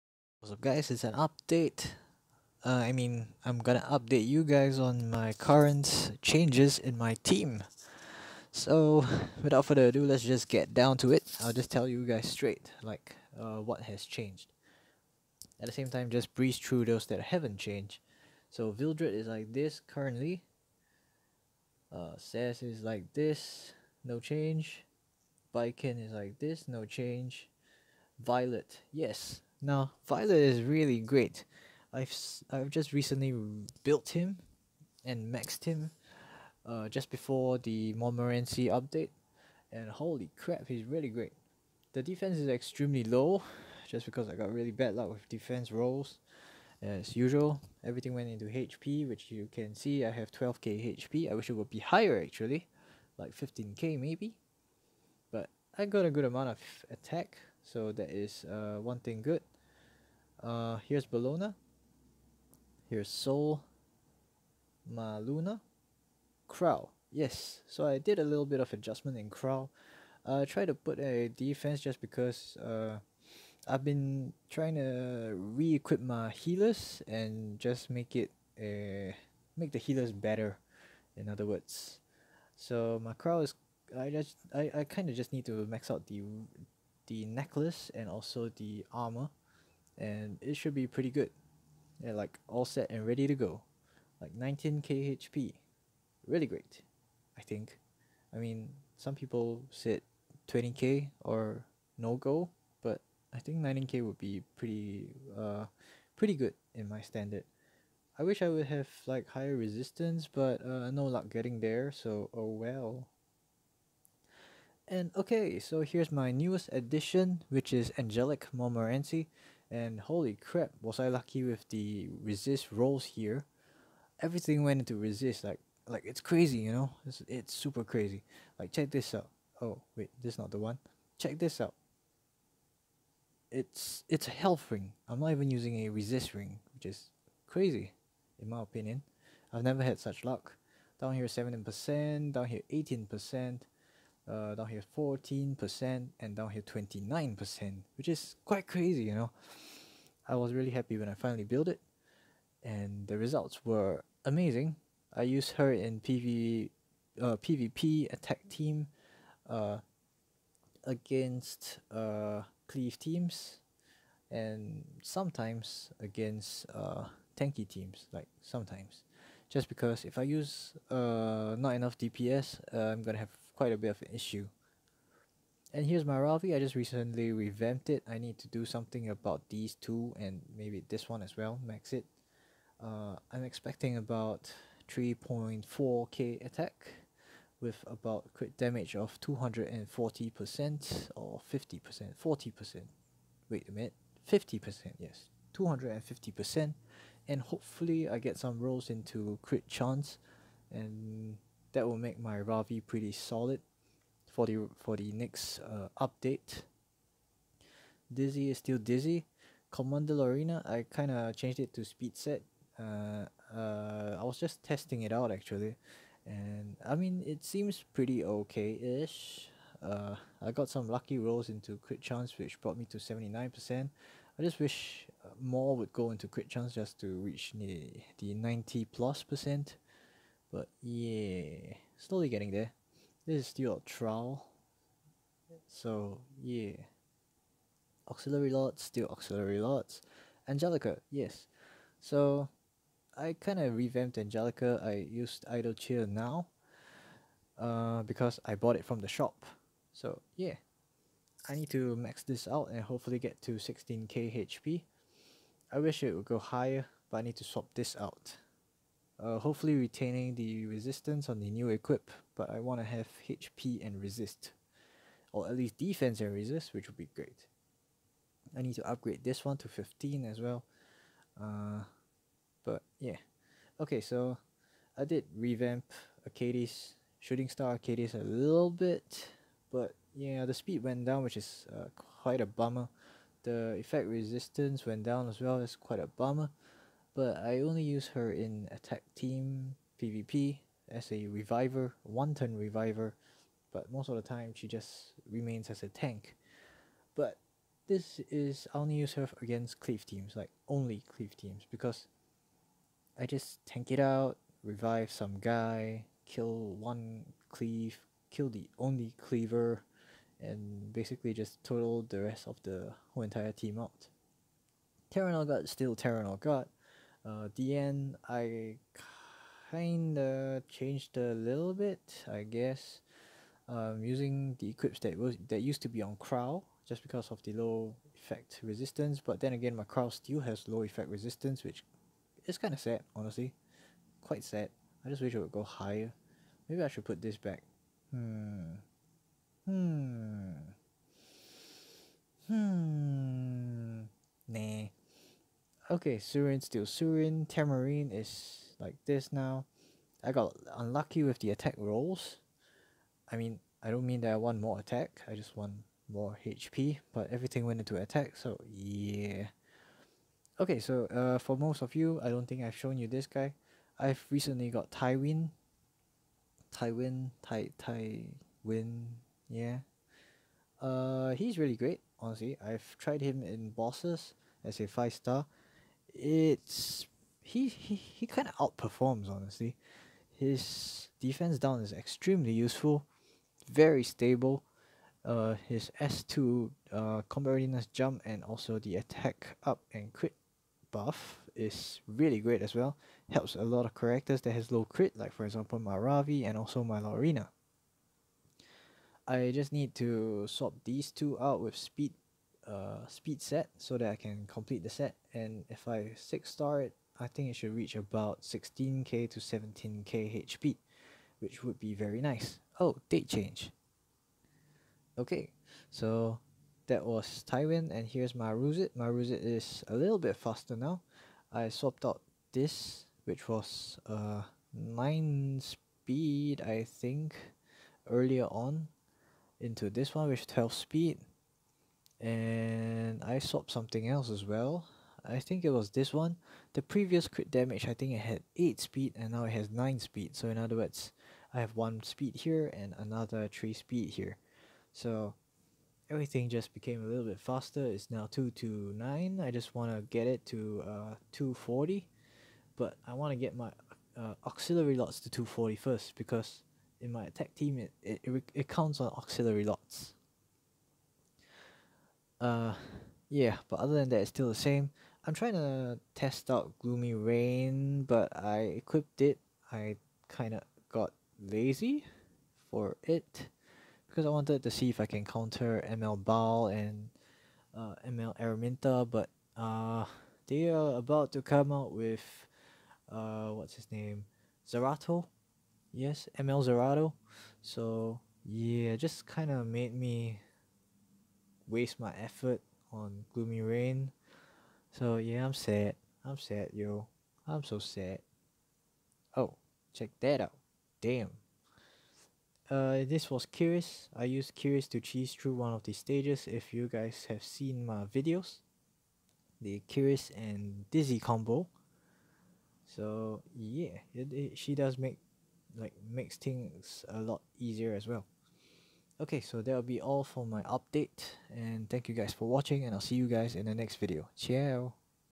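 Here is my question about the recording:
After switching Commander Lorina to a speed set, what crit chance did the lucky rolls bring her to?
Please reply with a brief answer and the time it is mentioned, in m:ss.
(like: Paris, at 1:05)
79%, at 3:42.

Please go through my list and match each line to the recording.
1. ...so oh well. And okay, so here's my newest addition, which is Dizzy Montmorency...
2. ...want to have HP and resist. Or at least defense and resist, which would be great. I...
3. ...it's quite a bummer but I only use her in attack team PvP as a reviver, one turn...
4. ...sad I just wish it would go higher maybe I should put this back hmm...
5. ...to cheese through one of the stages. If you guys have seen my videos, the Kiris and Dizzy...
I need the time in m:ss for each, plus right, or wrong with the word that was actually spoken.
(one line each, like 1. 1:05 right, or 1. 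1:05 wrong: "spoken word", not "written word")
1. 1:51 wrong: "Angelic", not "Dizzy"
2. 4:22 right
3. 4:45 right
4. 5:34 right
5. 8:24 right.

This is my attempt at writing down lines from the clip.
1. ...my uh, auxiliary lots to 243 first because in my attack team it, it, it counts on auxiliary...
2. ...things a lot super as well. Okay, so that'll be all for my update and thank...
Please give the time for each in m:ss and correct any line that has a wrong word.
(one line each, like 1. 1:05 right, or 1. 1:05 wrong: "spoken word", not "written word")
1. 7:33 wrong: "240", not "243"
2. 8:36 wrong: "easier", not "super".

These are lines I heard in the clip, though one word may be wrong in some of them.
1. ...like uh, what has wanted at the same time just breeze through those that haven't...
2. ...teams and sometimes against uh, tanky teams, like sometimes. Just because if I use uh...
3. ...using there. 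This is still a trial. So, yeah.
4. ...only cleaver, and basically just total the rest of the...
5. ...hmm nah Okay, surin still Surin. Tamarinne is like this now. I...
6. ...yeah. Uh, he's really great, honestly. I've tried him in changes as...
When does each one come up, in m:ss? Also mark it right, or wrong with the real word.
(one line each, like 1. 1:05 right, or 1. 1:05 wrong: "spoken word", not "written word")
1. 0:12 wrong: "changed", not "wanted"
2. 2:42 right
3. 3:52 wrong: "getting", not "using"
4. 5:08 right
5. 5:42 right
6. 6:09 wrong: "bosses", not "changes".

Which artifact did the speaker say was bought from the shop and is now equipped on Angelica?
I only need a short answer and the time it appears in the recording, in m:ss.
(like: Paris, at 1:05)
Idle Cheer, at 4:05.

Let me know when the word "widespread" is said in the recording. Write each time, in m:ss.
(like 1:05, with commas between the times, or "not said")
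not said.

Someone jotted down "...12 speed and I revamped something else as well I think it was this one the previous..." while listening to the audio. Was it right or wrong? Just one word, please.
wrong.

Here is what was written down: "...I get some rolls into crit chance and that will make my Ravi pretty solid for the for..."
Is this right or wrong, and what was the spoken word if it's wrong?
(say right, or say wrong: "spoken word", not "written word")
right.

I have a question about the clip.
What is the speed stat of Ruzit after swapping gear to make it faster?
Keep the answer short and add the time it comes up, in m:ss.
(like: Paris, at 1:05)
229, at 7:28.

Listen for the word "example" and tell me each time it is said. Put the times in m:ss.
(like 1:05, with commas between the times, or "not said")
6:35.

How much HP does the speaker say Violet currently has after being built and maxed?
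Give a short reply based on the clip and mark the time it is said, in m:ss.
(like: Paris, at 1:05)
12k, at 0:50.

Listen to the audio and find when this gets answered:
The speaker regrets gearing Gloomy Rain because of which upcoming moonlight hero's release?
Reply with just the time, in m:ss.
8:06.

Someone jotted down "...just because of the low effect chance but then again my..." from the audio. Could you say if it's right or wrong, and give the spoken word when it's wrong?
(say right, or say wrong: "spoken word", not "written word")
wrong: "resistance", not "chance".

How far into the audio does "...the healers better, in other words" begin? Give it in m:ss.
1:19.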